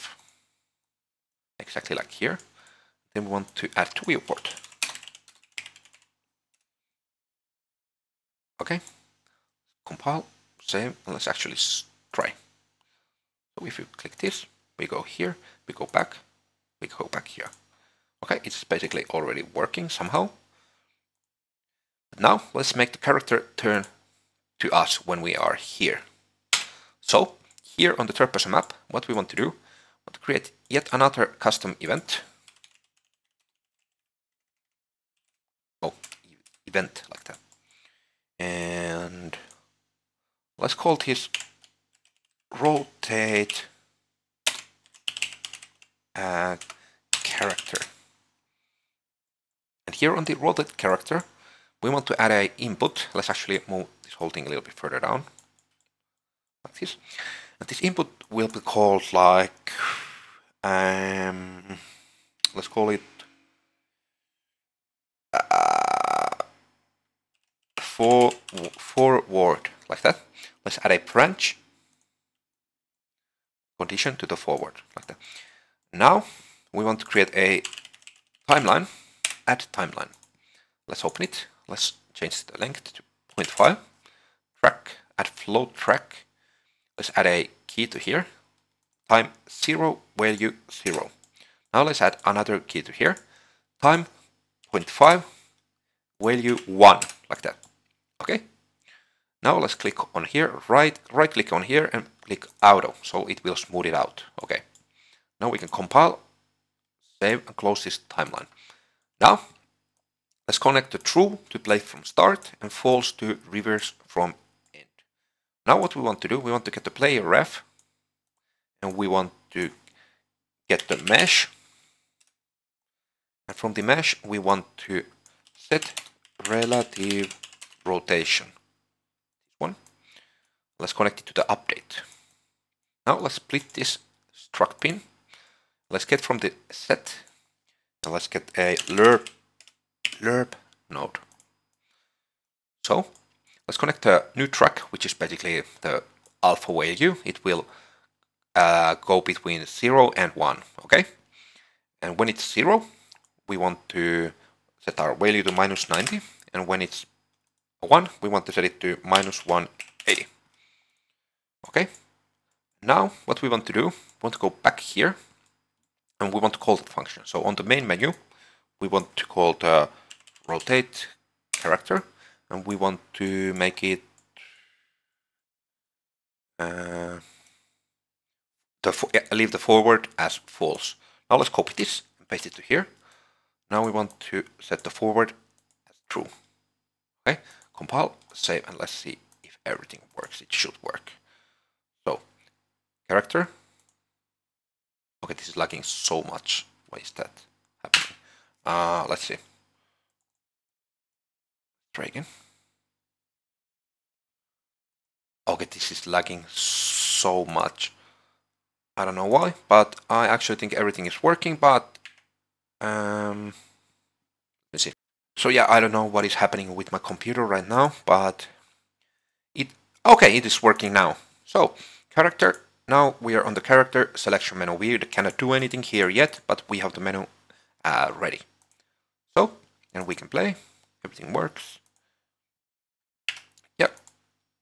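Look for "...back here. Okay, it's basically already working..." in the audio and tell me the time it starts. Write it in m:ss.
0:17.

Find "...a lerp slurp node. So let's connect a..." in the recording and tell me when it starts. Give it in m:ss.
2:18.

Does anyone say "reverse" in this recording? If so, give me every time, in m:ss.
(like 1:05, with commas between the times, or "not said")
1:53.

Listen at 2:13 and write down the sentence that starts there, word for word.
Now let's split this struct pin.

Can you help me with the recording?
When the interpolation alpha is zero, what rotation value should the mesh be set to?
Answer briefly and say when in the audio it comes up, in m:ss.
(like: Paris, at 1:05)
-90, at 2:35.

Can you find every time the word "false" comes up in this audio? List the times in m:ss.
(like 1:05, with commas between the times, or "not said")
1:52, 3:00.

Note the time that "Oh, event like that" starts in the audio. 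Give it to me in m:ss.
0:35.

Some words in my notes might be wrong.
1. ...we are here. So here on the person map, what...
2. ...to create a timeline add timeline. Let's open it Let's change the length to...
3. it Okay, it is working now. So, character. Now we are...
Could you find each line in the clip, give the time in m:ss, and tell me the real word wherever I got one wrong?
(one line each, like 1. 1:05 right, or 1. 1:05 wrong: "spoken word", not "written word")
1. 0:25 right
2. 1:16 right
3. 3:39 right.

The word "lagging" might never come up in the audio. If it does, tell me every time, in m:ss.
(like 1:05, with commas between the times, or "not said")
3:15, 3:26.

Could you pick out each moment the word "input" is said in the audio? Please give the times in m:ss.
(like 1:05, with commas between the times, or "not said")
0:52, 0:57.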